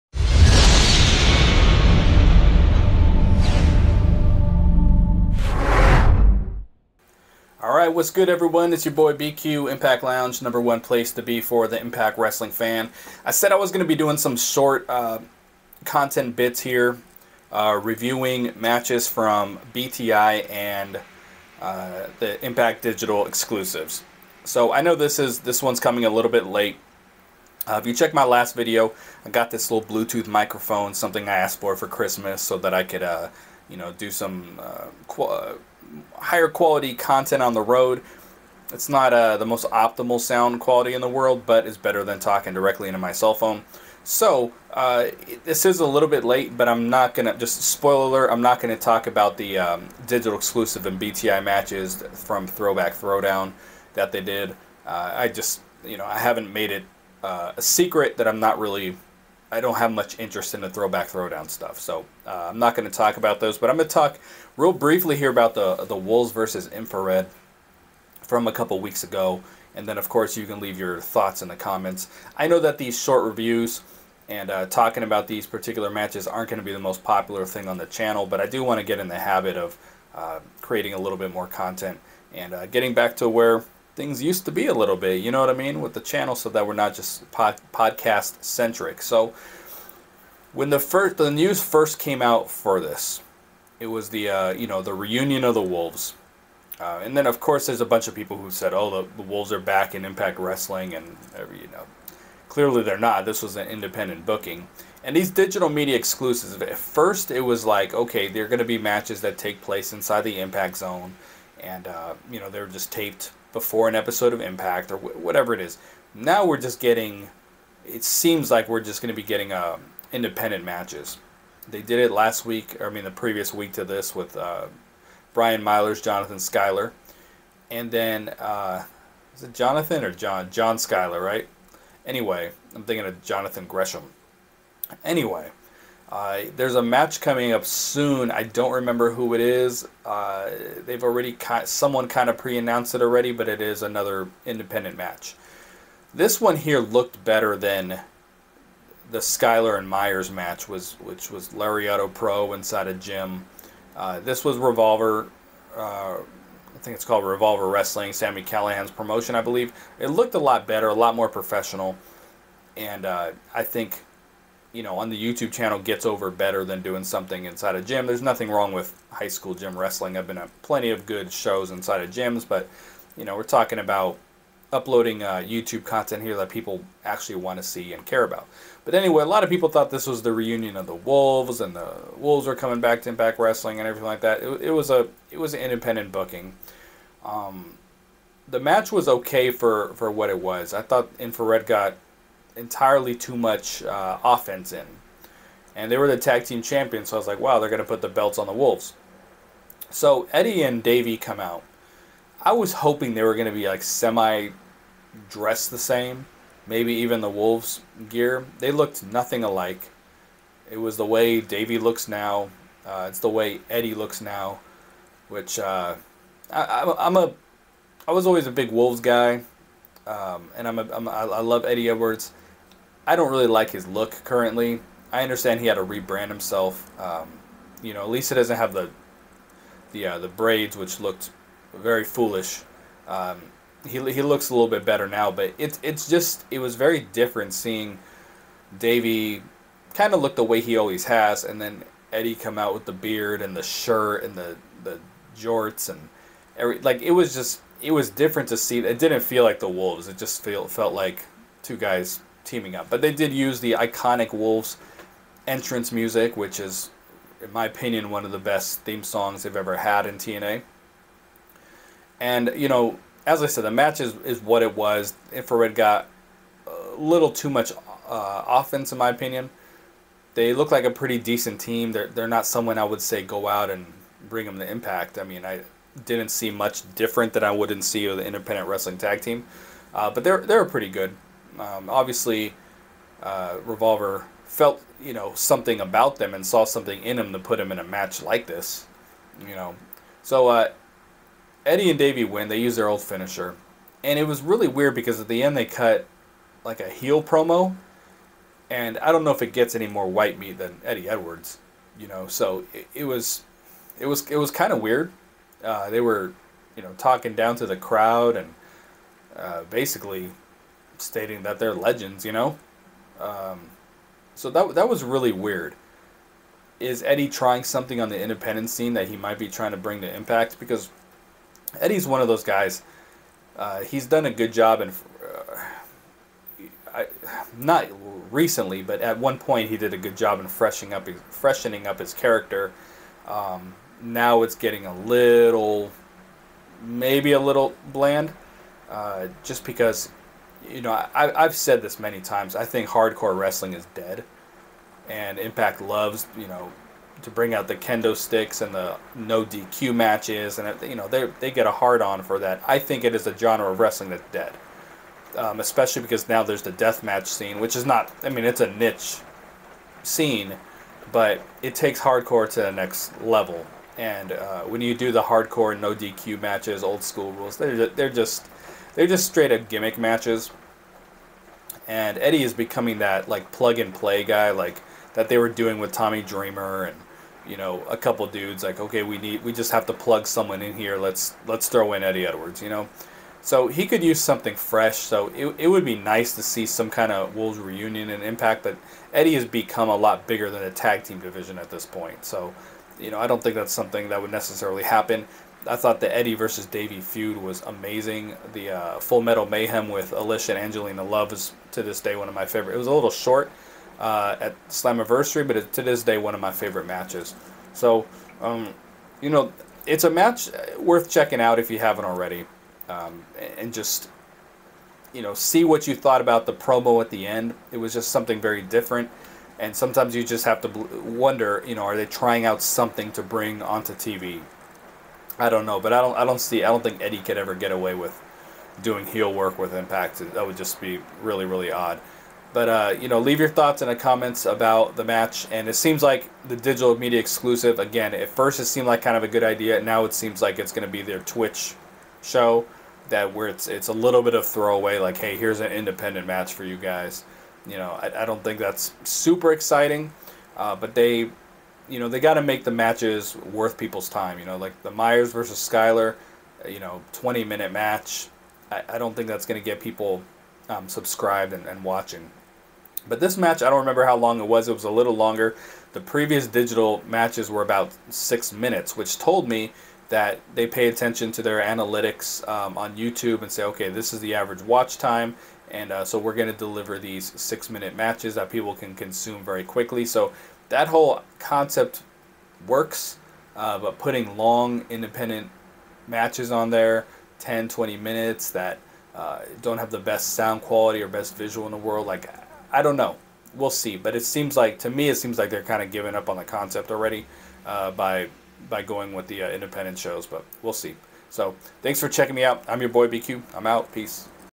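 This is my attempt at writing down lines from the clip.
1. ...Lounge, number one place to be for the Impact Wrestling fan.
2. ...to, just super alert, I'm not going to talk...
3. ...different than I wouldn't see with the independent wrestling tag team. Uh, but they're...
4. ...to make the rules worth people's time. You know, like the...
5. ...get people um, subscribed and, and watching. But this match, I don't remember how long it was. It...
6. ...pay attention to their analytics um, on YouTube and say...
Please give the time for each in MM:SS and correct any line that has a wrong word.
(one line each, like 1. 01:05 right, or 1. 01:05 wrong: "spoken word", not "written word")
1. 00:10 right
2. 00:47 wrong: "spoiler", not "super"
3. 04:36 right
4. 07:32 wrong: "matches", not "rules"
5. 07:39 right
6. 07:50 right.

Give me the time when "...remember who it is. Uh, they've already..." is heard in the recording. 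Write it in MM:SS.
02:18.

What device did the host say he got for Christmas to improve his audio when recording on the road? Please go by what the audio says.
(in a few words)
Bluetooth microphone.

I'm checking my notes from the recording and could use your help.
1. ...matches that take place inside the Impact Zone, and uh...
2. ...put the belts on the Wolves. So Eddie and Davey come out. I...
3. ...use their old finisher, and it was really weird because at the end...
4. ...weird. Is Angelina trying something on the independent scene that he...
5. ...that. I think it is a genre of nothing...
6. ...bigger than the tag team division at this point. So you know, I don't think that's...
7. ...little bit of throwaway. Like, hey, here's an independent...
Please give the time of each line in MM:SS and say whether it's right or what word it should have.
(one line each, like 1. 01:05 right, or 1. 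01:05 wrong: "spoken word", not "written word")
1. 01:48 right
2. 03:17 right
3. 04:52 right
4. 05:15 wrong: "Eddie", not "Angelina"
5. 05:52 wrong: "wrestling", not "nothing"
6. 06:30 right
7. 07:23 right.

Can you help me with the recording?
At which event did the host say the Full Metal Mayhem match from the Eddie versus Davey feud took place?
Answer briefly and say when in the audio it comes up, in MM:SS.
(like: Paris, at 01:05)
Slammiversary, at 06:44.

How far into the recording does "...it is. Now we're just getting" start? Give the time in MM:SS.
01:55.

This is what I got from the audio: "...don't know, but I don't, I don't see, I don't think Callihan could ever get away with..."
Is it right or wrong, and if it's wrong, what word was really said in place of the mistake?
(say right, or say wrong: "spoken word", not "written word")
wrong: "Eddie", not "Callihan".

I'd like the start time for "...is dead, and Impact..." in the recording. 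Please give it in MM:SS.
05:43.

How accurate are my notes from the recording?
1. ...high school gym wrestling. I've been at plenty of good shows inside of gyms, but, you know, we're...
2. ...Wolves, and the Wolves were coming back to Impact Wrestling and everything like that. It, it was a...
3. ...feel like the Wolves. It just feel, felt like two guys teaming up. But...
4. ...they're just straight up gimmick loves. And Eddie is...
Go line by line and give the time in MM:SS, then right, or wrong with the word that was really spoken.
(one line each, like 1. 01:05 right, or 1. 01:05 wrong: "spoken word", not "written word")
1. 02:49 right
2. 03:00 right
3. 04:09 right
4. 06:08 wrong: "matches", not "loves".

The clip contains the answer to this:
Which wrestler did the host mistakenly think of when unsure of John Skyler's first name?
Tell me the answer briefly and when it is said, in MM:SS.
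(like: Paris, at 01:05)
Jonathan Gresham, at 02:13.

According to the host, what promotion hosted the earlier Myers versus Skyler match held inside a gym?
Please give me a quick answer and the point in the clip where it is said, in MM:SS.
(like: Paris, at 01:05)
Lariato Pro, at 02:31.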